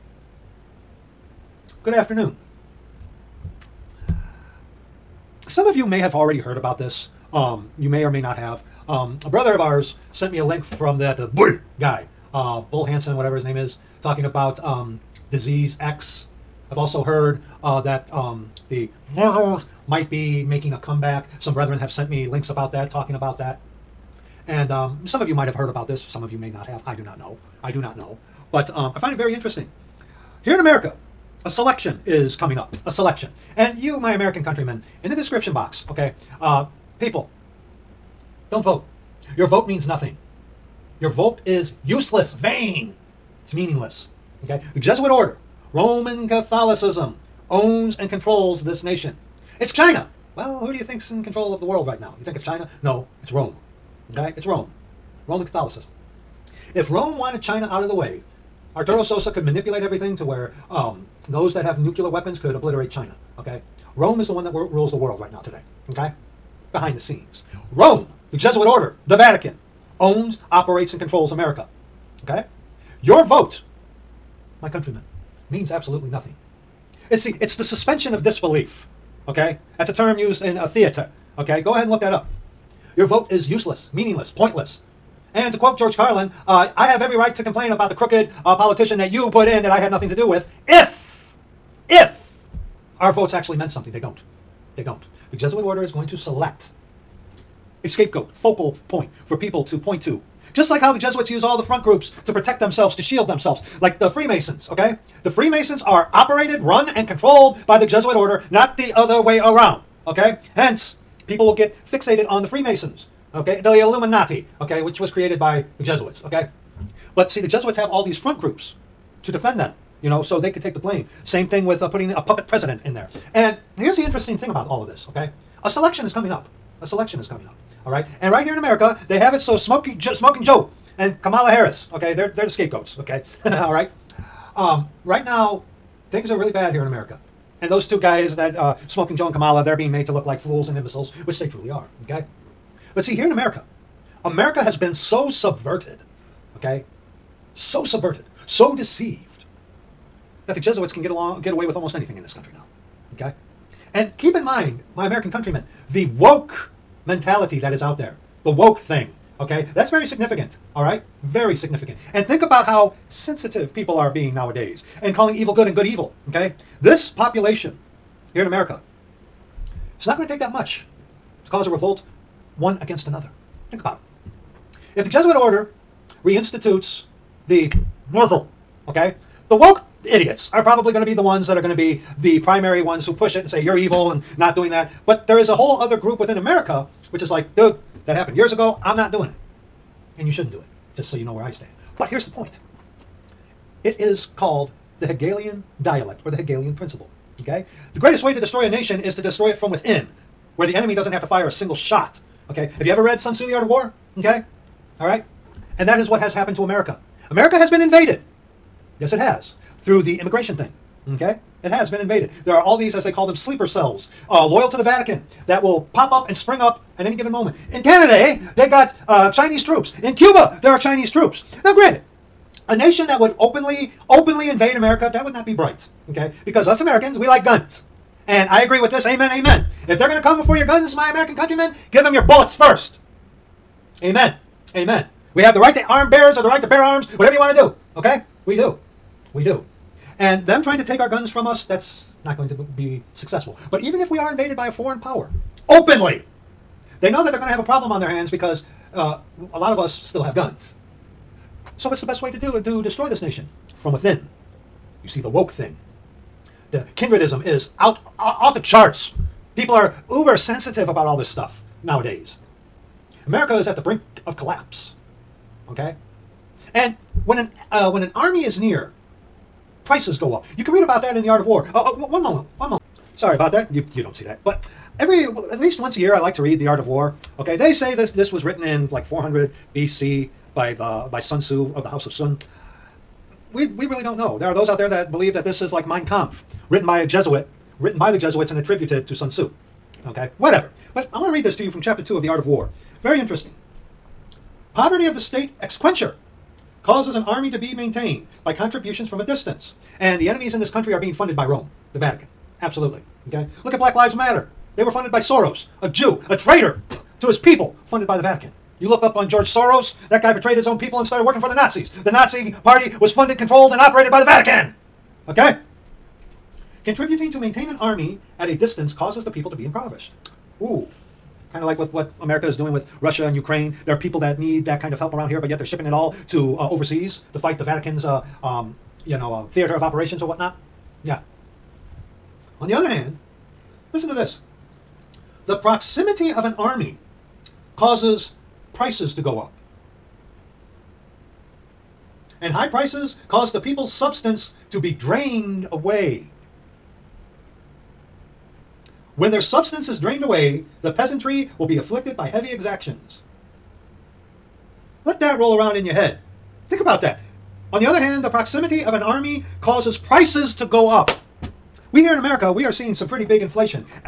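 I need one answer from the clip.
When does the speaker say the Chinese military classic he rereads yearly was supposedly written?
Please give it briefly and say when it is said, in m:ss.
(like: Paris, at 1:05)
400 BC, at 4:39.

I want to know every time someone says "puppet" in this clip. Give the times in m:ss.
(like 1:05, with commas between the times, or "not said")
2:02.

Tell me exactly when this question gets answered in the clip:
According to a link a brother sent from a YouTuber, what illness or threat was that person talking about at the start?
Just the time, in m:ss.
0:15.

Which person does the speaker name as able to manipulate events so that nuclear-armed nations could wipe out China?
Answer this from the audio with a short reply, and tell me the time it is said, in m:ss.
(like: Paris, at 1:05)
Arturo Sosa, at 0:58.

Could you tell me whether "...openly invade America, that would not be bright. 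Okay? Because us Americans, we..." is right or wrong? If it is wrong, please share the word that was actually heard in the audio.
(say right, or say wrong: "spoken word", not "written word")
right.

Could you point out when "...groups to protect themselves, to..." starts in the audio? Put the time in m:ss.
1:41.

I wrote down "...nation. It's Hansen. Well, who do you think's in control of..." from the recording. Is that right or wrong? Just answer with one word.
wrong.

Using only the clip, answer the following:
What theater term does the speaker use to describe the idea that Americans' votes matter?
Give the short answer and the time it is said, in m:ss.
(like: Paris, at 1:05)
suspension of disbelief, at 1:17.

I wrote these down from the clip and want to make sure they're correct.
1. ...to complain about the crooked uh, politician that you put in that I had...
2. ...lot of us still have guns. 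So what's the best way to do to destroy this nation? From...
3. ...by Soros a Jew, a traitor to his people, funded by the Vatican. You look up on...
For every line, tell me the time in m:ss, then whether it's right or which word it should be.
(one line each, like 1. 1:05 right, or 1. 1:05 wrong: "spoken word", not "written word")
1. 1:27 right
2. 4:09 right
3. 5:05 right.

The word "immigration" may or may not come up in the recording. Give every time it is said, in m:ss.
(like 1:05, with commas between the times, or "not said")
3:30.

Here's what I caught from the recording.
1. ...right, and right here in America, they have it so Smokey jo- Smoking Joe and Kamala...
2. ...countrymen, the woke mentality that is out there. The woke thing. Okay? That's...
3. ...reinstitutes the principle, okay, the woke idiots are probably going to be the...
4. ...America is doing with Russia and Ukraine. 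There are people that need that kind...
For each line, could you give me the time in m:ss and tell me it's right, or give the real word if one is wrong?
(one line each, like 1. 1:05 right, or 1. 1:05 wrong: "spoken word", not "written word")
1. 2:07 right
2. 2:35 right
3. 2:56 wrong: "muzzle", not "principle"
4. 5:22 right.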